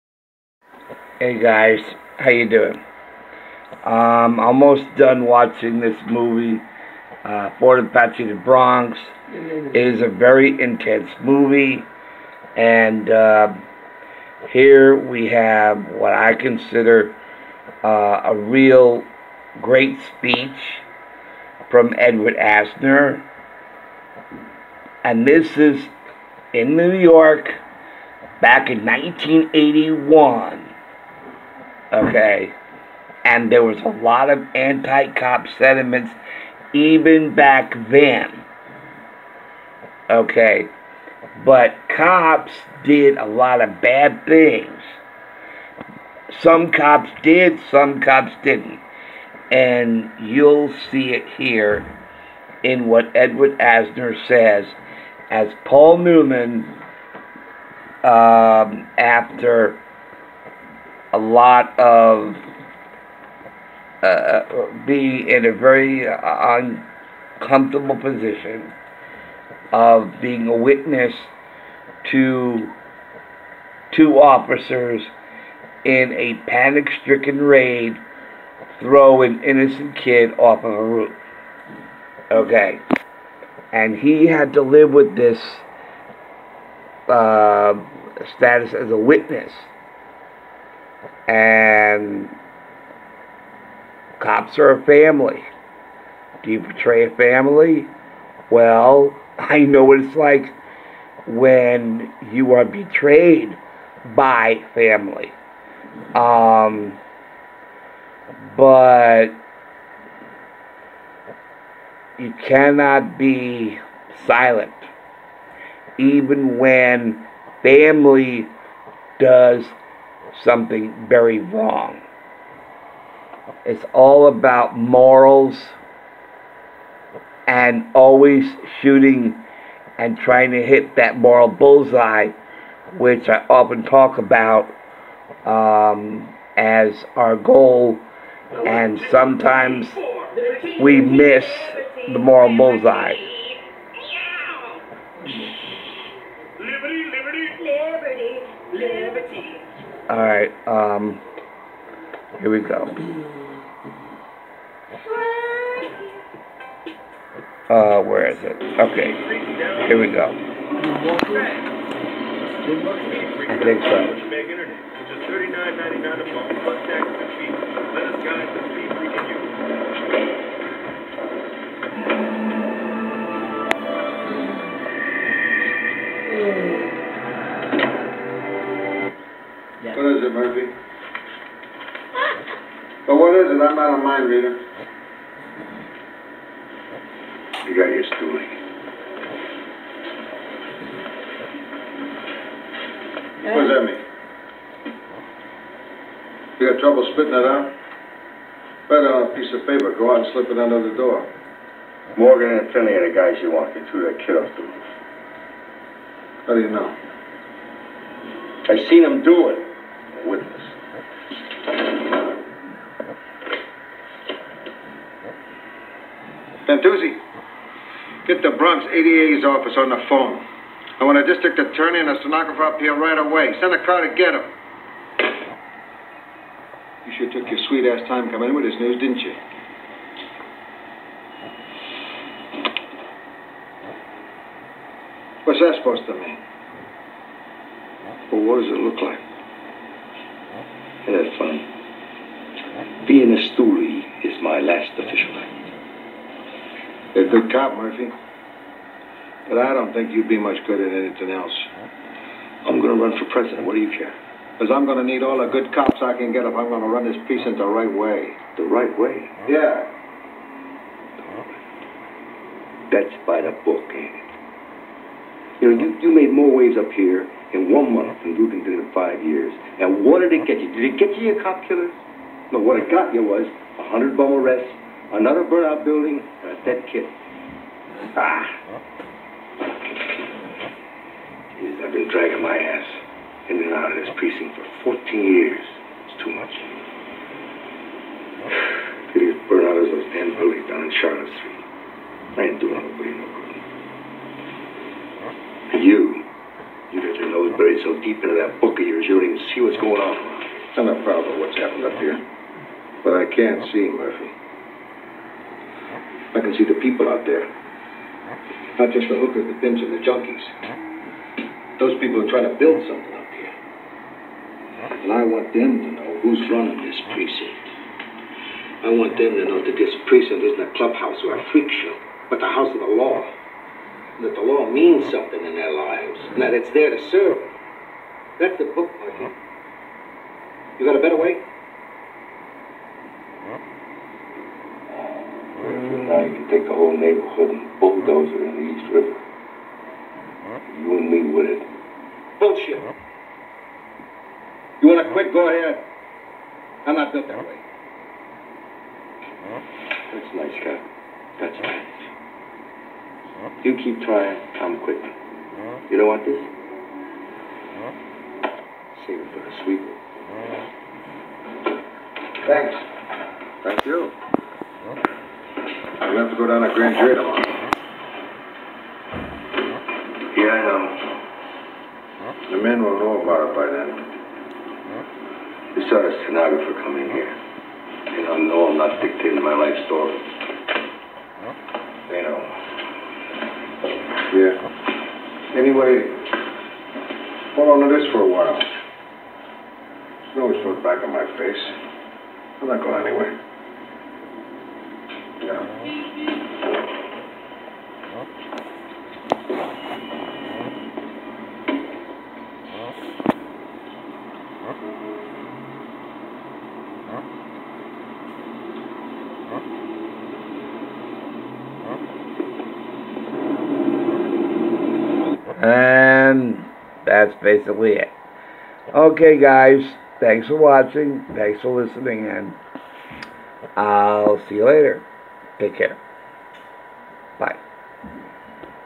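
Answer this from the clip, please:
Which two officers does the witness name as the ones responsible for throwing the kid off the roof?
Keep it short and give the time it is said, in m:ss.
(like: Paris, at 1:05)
Morgan and Finley, at 3:22.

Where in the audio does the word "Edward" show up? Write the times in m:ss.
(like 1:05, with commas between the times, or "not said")
0:21, 0:53.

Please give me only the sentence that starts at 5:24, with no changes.
And that the law means something in their lives, and that it's there to serve them.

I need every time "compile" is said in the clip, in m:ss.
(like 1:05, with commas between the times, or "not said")
not said.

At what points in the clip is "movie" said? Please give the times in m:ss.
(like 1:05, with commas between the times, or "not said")
0:06, 0:11.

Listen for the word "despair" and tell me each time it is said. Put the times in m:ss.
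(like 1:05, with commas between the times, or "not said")
not said.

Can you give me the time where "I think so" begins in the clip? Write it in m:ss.
2:43.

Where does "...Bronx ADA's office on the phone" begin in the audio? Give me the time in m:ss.
3:38.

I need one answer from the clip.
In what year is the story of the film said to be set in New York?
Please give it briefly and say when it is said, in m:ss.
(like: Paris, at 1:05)
1981, at 0:28.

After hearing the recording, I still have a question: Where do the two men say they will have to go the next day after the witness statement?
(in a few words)
Grand Jury.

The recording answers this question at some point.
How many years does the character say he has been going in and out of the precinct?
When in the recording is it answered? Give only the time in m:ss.
4:44.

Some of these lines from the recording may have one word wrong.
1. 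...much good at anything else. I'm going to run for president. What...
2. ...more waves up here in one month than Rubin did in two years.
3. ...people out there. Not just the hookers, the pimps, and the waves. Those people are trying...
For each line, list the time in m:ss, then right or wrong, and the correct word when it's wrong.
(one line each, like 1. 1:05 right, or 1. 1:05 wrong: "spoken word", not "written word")
1. 4:10 right
2. 4:26 wrong: "five", not "two"
3. 5:06 wrong: "junkies", not "waves".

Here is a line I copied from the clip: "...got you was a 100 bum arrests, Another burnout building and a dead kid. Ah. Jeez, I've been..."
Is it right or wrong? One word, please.
right.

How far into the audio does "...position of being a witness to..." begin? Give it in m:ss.
1:07.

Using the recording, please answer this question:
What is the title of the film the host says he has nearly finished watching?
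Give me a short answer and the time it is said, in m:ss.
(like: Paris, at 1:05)
Fort Apache the Bronx, at 0:07.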